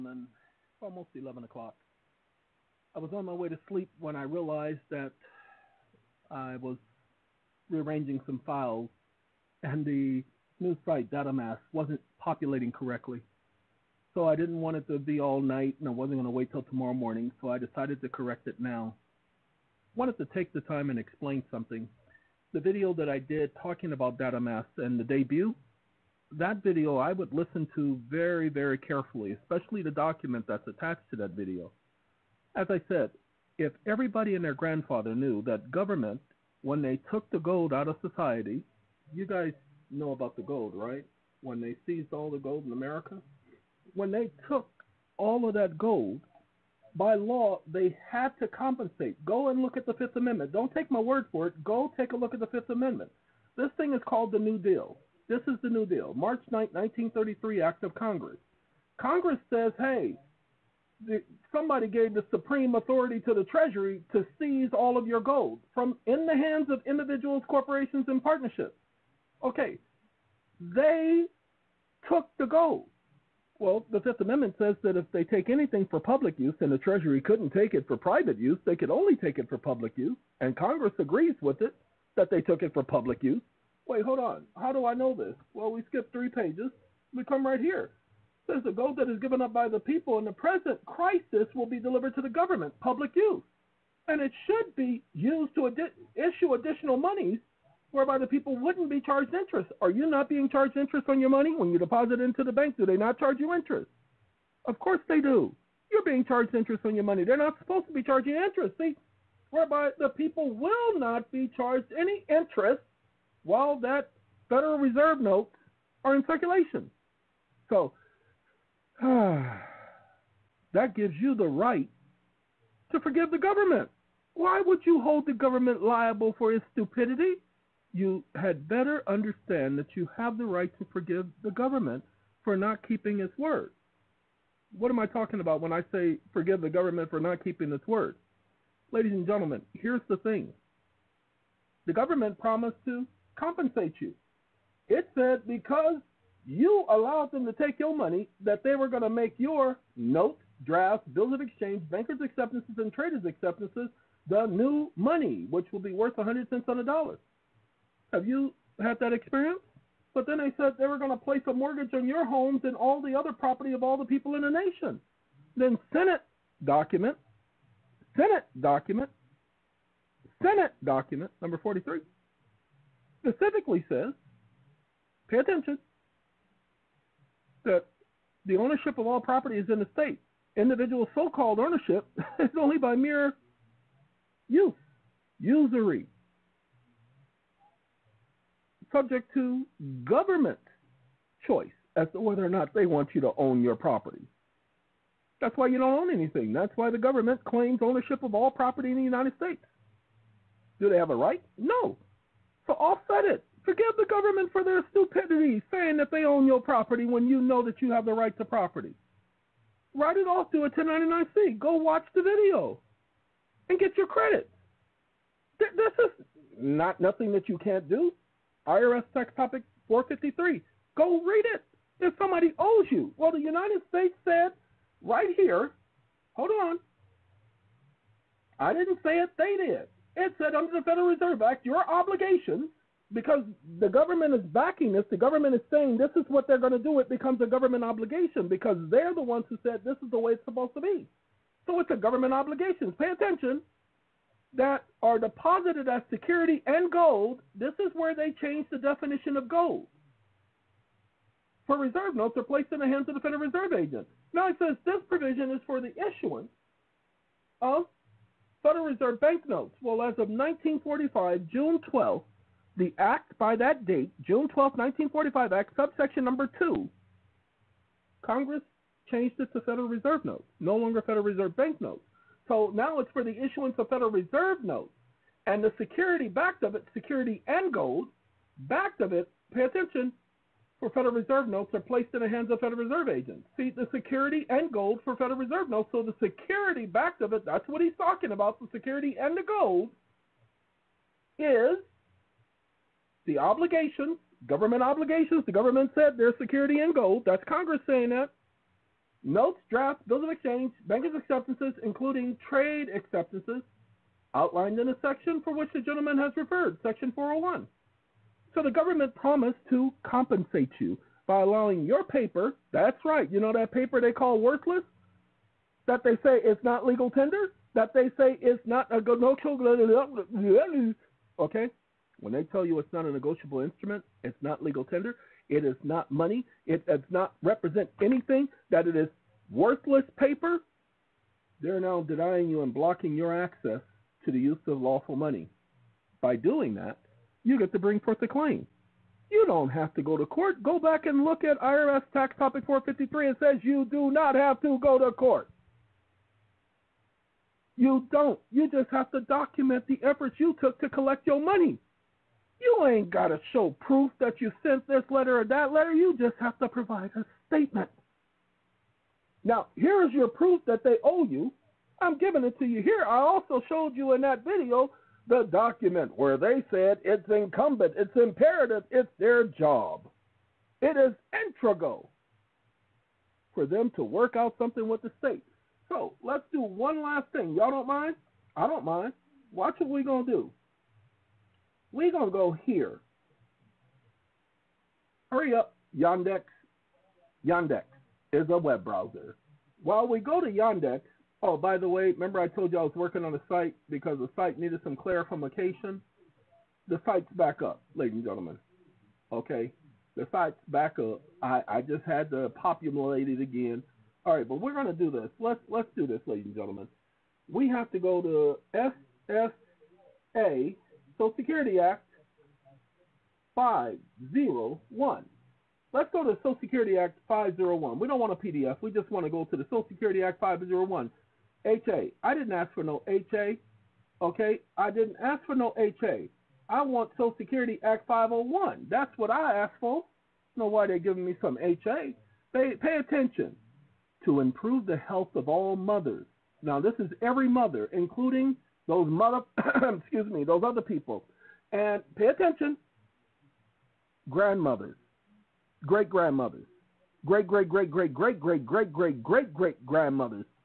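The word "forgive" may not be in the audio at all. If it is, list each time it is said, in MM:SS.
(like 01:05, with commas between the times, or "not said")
02:03, 02:10, 02:16, 03:23.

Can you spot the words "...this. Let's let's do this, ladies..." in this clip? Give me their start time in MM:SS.
06:45.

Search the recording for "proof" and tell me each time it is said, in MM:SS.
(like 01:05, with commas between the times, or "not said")
05:53, 06:00.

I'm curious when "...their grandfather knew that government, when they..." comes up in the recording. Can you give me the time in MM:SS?
00:34.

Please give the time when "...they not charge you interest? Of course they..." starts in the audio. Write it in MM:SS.
01:42.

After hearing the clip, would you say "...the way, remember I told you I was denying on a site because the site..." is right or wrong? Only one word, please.
wrong.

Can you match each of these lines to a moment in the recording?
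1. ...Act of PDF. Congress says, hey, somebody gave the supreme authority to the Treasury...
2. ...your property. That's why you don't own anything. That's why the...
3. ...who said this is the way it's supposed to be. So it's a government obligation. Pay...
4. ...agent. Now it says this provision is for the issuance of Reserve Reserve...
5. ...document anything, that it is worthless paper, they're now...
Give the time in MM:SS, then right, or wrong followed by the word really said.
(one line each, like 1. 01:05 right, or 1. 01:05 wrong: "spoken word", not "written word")
1. 00:57 wrong: "Congress", not "PDF"
2. 03:13 right
3. 03:59 right
4. 04:13 wrong: "Federal", not "Reserve"
5. 05:27 wrong: "represent", not "document".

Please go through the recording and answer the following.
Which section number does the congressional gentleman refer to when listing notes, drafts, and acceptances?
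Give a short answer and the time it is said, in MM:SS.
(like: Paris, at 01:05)
Section 401, at 05:06.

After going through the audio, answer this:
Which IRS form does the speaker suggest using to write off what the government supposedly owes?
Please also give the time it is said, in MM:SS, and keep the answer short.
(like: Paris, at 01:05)
1099-C, at 03:30.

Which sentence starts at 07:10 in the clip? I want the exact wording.
know why they're giving me some HA.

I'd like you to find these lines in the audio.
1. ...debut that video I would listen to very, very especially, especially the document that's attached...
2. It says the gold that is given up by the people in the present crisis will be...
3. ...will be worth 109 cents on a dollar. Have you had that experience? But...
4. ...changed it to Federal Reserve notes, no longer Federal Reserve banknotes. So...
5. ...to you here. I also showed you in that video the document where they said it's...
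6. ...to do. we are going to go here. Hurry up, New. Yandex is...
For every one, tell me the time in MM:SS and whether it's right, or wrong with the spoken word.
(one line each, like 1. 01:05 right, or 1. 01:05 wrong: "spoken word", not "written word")
1. 00:25 wrong: "carefully", not "especially"
2. 01:28 right
3. 02:35 wrong: "100", not "109"
4. 04:29 right
5. 06:02 right
6. 06:20 wrong: "Yandex", not "New".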